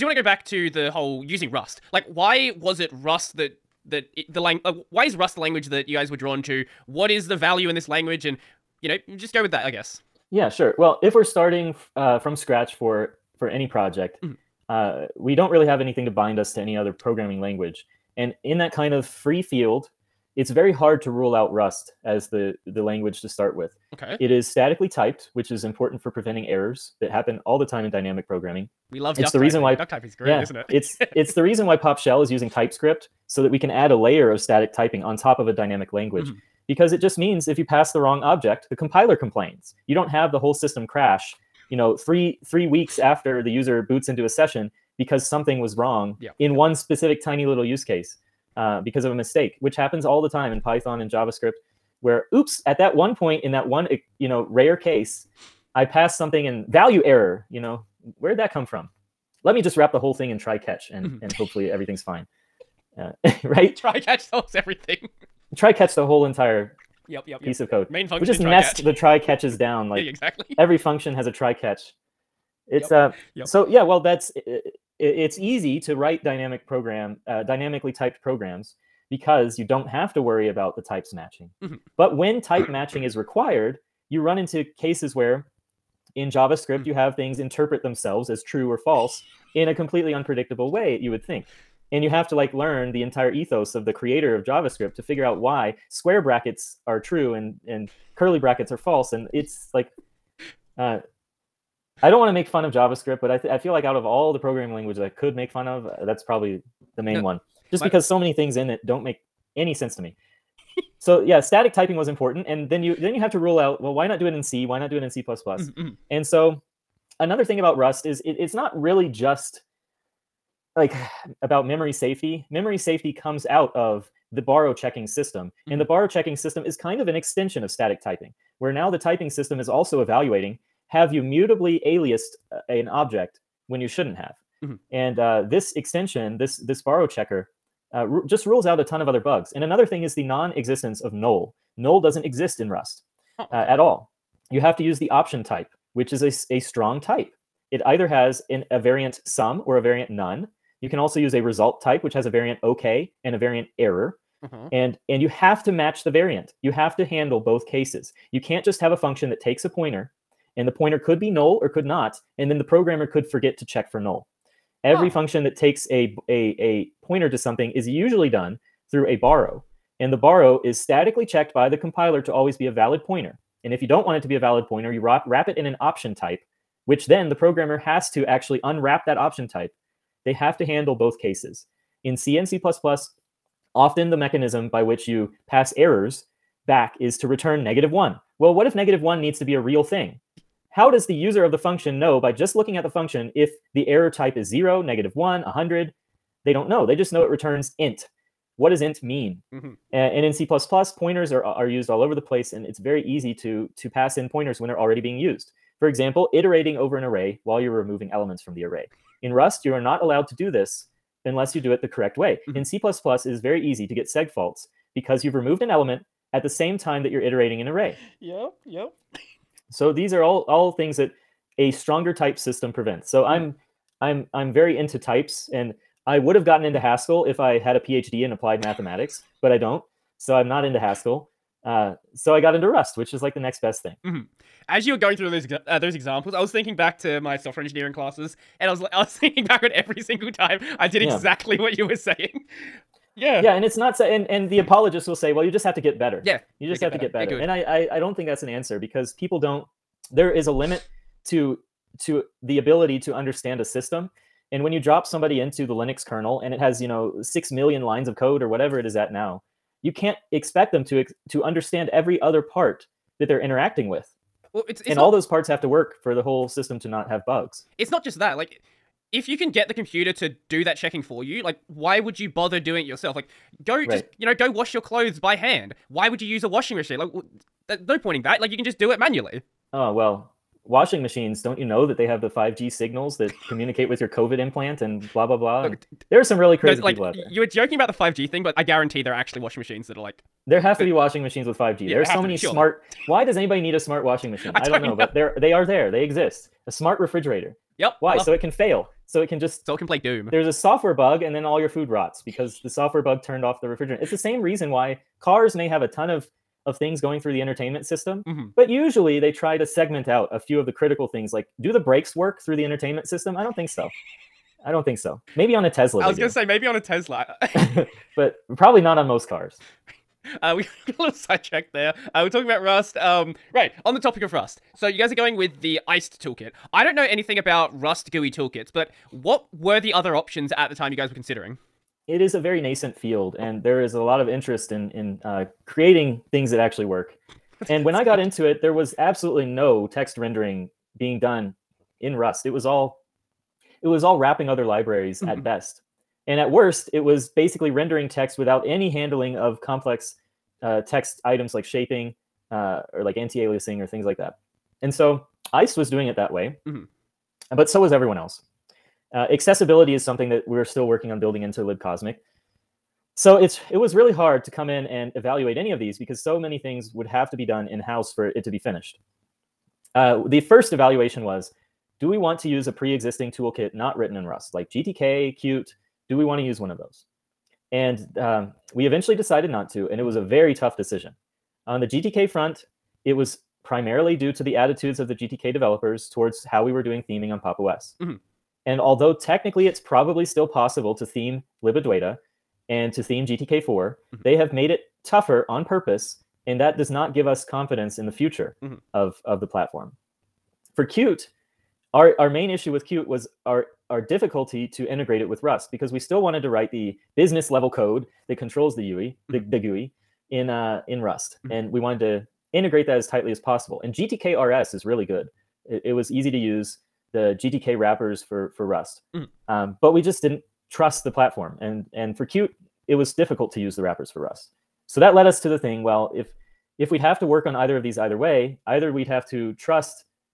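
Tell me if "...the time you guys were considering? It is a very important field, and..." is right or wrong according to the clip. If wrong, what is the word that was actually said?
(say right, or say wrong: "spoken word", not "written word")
wrong: "nascent", not "important".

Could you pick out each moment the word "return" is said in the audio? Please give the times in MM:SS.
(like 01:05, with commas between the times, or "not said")
03:07, 03:17.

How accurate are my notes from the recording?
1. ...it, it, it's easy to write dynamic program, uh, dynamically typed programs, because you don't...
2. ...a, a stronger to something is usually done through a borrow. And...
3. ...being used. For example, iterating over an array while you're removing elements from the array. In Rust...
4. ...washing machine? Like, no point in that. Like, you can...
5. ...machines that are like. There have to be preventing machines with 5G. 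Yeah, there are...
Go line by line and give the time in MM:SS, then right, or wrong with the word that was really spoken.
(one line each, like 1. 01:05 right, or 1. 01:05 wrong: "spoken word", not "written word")
1. 01:14 right
2. 02:46 wrong: "pointer", not "stronger"
3. 03:25 right
4. 04:36 right
5. 04:49 wrong: "washing", not "preventing".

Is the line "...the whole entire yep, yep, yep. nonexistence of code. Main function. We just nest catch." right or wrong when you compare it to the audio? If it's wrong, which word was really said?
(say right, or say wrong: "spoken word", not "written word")
wrong: "piece", not "nonexistence".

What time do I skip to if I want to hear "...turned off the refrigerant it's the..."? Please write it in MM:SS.
05:03.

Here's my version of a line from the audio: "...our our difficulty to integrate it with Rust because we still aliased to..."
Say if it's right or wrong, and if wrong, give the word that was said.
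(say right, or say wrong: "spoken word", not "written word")
wrong: "wanted", not "aliased".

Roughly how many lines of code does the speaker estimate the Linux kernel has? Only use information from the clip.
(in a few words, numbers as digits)
6 million.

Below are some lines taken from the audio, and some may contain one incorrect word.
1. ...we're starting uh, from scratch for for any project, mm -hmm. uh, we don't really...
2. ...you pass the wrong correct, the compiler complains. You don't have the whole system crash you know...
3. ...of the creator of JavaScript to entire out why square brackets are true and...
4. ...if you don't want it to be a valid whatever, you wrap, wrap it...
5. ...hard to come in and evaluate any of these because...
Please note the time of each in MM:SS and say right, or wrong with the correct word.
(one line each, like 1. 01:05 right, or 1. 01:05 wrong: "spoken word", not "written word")
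1. 00:11 right
2. 00:37 wrong: "object", not "correct"
3. 01:33 wrong: "figure", not "entire"
4. 02:53 wrong: "pointer", not "whatever"
5. 06:04 right.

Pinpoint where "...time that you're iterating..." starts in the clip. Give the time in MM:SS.
03:36.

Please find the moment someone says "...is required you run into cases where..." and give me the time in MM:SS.
01:23.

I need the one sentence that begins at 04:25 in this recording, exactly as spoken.
all those parts have to work for the whole system to not have bugs it's not just that.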